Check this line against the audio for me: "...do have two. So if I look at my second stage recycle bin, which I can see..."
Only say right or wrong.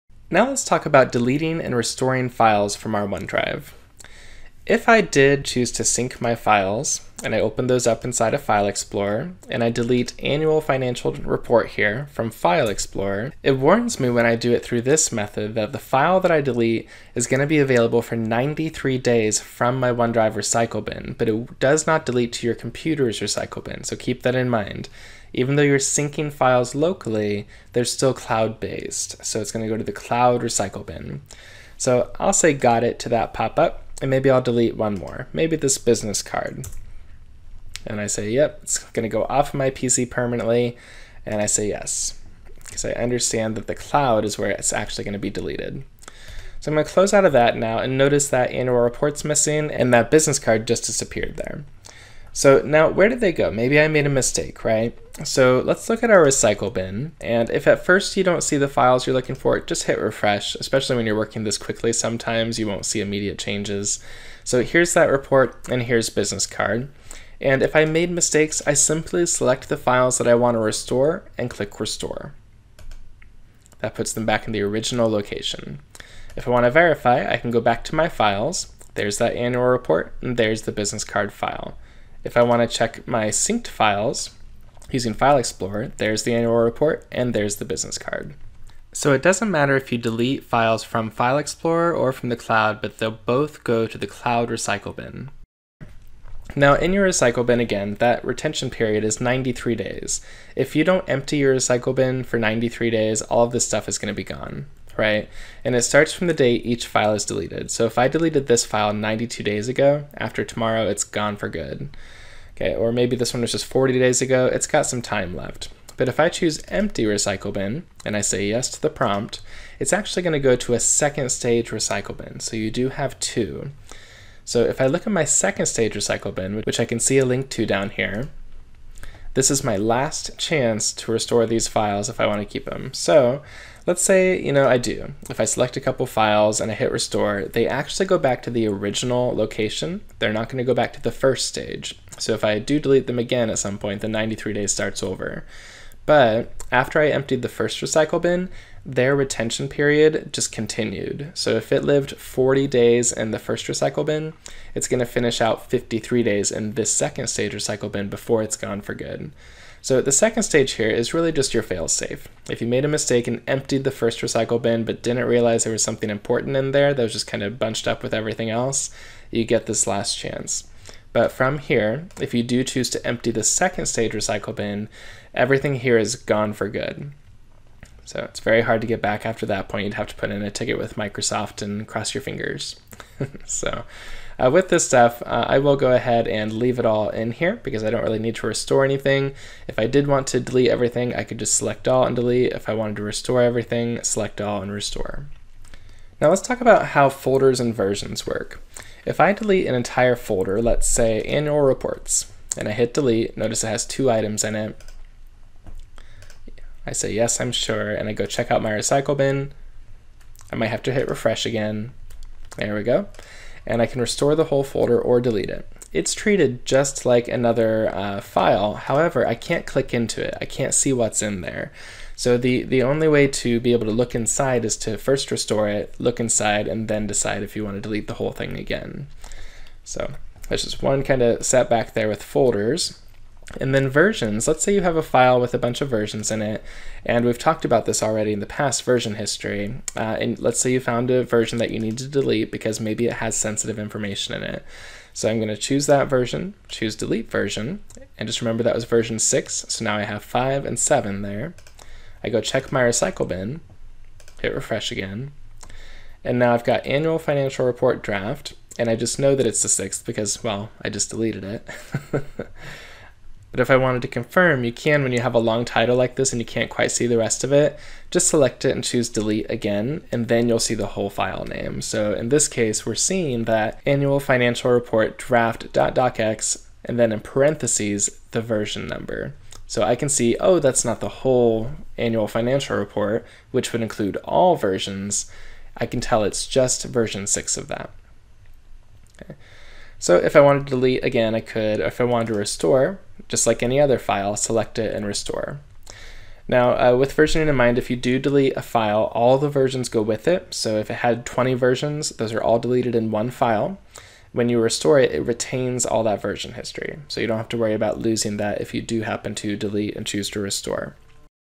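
right.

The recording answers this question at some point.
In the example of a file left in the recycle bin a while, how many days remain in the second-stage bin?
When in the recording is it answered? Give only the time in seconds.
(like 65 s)
155 s.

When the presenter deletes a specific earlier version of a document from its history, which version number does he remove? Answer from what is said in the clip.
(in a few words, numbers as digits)
6.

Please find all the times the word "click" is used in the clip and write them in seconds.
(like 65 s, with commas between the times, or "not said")
71 s, 219 s.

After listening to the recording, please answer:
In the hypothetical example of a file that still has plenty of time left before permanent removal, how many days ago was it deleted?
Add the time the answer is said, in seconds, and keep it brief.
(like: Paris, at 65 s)
40, at 113 s.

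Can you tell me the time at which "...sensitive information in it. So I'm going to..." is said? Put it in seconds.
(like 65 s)
243 s.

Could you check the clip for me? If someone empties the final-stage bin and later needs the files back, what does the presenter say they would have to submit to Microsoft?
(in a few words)
a ticket.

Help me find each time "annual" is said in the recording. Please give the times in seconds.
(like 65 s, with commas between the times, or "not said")
10 s, 48 s, 79 s, 86 s, 201 s, 256 s, 273 s, 281 s.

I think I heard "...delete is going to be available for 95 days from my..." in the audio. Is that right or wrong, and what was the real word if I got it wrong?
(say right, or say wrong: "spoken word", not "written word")
wrong: "93", not "95".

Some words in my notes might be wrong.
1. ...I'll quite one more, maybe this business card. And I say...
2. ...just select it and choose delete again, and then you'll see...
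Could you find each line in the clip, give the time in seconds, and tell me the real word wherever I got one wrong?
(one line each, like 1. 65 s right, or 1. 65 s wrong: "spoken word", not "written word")
1. 34 s wrong: "delete", not "quite"
2. 268 s right.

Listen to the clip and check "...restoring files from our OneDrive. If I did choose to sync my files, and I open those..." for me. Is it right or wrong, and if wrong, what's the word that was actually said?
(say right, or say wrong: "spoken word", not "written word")
right.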